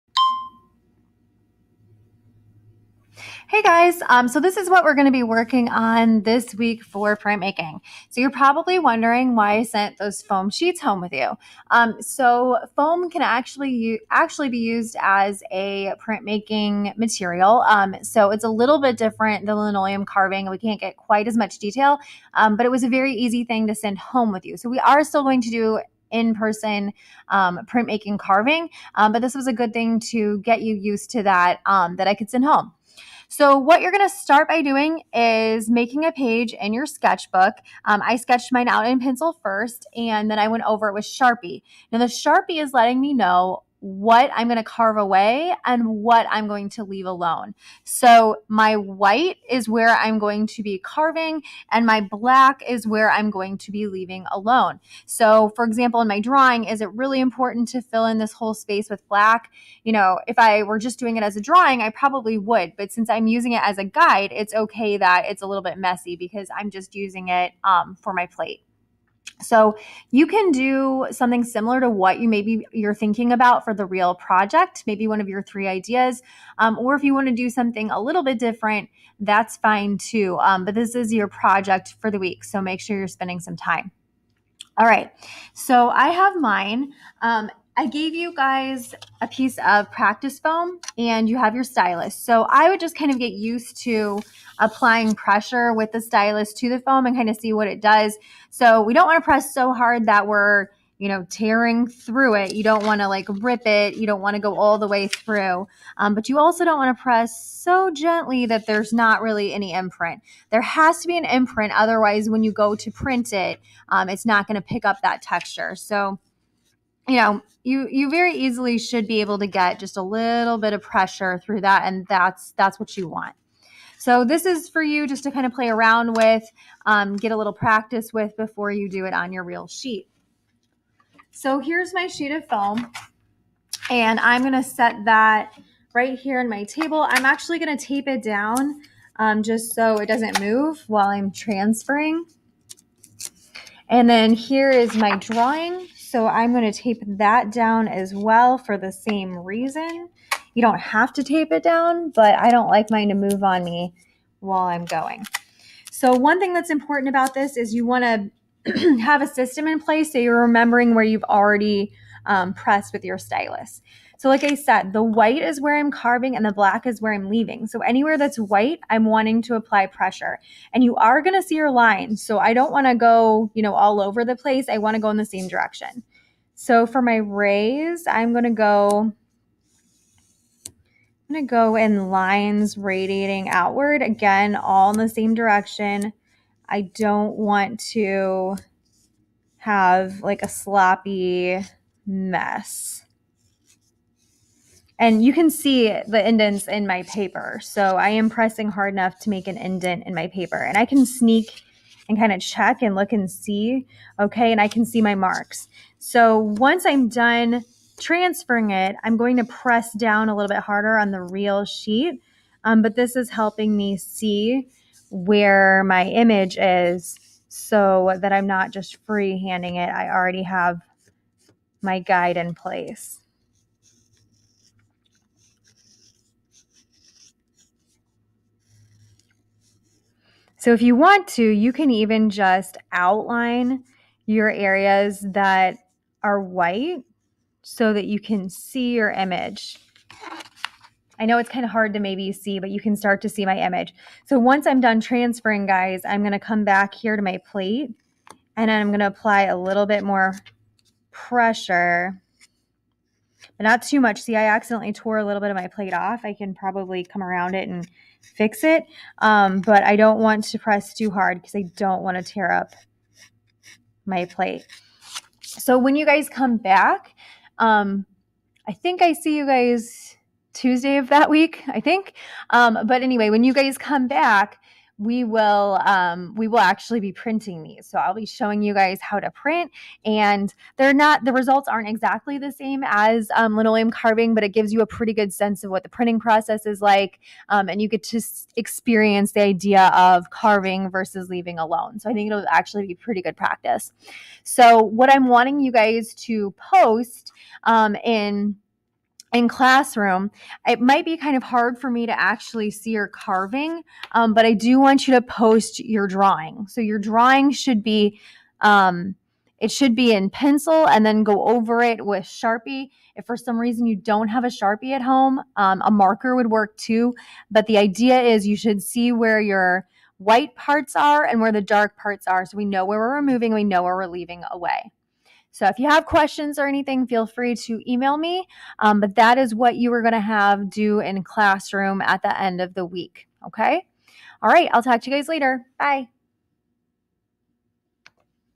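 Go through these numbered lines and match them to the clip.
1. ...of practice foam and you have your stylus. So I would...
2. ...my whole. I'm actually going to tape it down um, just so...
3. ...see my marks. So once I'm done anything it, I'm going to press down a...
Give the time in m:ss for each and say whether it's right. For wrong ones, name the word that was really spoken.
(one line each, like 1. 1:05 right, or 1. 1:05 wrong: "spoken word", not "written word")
1. 1:29 right
2. 2:16 wrong: "table", not "whole"
3. 3:24 wrong: "transferring", not "anything".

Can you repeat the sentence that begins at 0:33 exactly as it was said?
So, what you're going to start by doing is making a page in your sketchbook.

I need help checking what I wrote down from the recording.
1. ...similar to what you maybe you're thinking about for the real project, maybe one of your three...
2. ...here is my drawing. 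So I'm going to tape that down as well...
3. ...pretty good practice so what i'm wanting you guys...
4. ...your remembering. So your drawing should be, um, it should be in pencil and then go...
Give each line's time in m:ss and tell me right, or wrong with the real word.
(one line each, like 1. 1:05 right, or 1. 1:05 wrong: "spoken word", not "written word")
1. 1:11 right
2. 2:24 right
3. 4:52 right
4. 5:05 wrong: "drawing", not "remembering".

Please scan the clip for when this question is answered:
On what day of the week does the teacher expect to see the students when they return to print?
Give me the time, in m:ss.
4:30.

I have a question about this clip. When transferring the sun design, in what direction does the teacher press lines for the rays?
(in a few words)
Radiating outward.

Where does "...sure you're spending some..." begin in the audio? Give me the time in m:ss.
1:22.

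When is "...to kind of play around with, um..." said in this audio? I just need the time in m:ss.
2:05.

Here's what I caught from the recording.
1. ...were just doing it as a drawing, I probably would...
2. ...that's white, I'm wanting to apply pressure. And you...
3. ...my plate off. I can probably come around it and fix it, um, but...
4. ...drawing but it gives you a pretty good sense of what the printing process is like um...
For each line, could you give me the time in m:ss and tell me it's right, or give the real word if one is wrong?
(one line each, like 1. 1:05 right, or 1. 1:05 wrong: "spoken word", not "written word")
1. 1:00 right
2. 2:48 right
3. 4:15 right
4. 4:43 wrong: "carving", not "drawing".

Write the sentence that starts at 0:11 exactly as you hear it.
Um, so foam can actually actually be used as a printmaking material.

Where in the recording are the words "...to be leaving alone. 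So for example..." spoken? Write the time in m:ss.
0:53.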